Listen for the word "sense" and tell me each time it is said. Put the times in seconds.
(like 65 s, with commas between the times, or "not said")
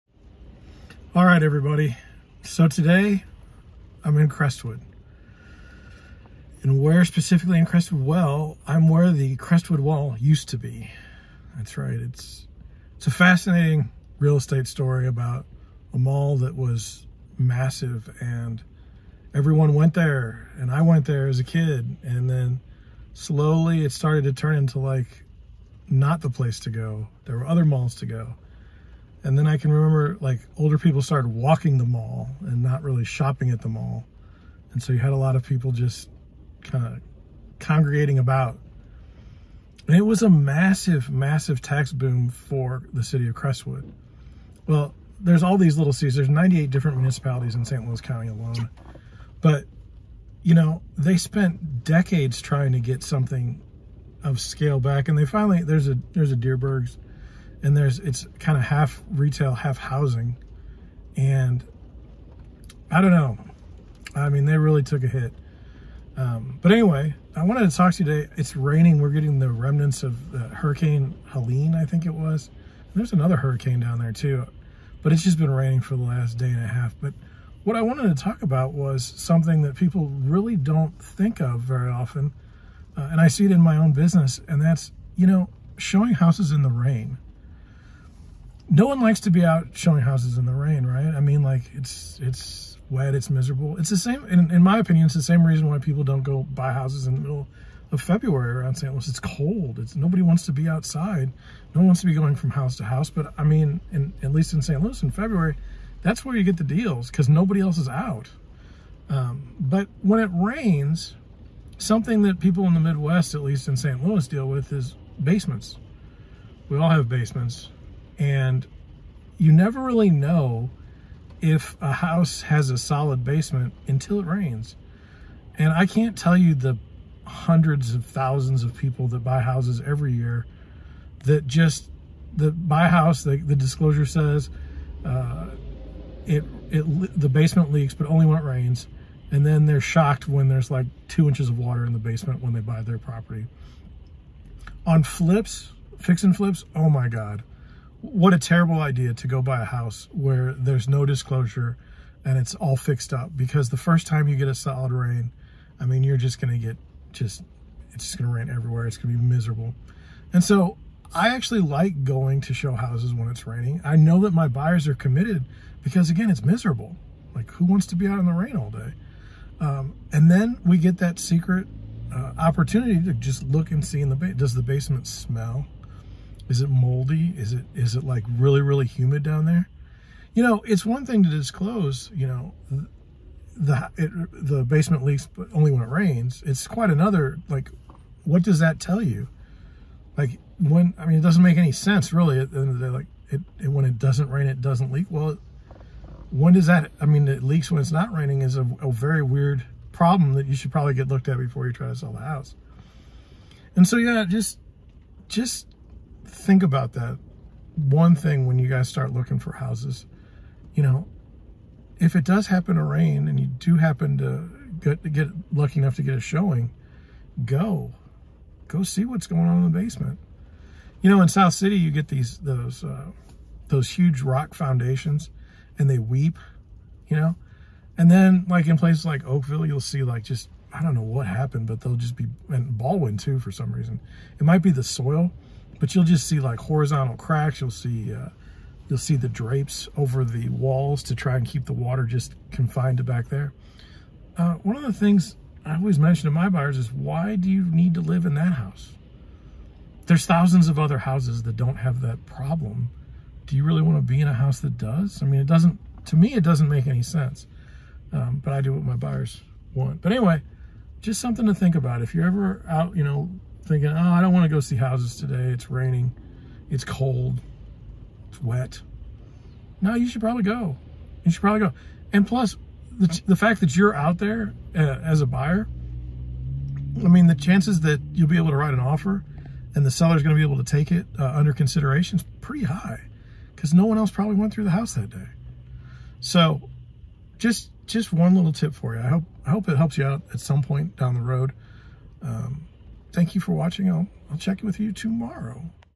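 191 s, 257 s.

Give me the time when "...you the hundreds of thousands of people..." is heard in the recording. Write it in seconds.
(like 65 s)
126 s.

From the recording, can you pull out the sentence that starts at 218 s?
Go see what's going on in the basement.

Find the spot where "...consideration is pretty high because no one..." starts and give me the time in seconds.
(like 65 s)
281 s.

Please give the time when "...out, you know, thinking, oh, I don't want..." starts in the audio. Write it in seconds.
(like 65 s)
262 s.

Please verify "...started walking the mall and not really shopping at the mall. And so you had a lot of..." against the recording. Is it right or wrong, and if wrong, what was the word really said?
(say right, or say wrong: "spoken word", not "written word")
right.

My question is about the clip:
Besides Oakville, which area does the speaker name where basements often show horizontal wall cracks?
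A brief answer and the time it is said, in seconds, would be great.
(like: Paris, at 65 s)
Ballwin, at 232 s.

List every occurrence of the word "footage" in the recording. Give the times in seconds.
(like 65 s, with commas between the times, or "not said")
not said.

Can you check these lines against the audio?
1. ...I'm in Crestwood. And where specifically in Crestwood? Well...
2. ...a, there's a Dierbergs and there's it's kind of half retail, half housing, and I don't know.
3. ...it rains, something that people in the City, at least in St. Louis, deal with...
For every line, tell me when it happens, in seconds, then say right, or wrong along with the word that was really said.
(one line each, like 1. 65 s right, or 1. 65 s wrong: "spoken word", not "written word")
1. 4 s right
2. 55 s right
3. 110 s wrong: "Midwest", not "City".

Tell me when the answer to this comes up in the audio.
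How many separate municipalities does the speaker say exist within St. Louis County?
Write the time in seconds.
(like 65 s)
46 s.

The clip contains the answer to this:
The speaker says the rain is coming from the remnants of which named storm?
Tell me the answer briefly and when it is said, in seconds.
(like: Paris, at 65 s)
Hurricane Helene, at 70 s.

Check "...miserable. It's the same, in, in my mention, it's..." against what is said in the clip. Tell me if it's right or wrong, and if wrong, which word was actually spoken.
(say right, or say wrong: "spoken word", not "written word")
wrong: "opinion", not "mention".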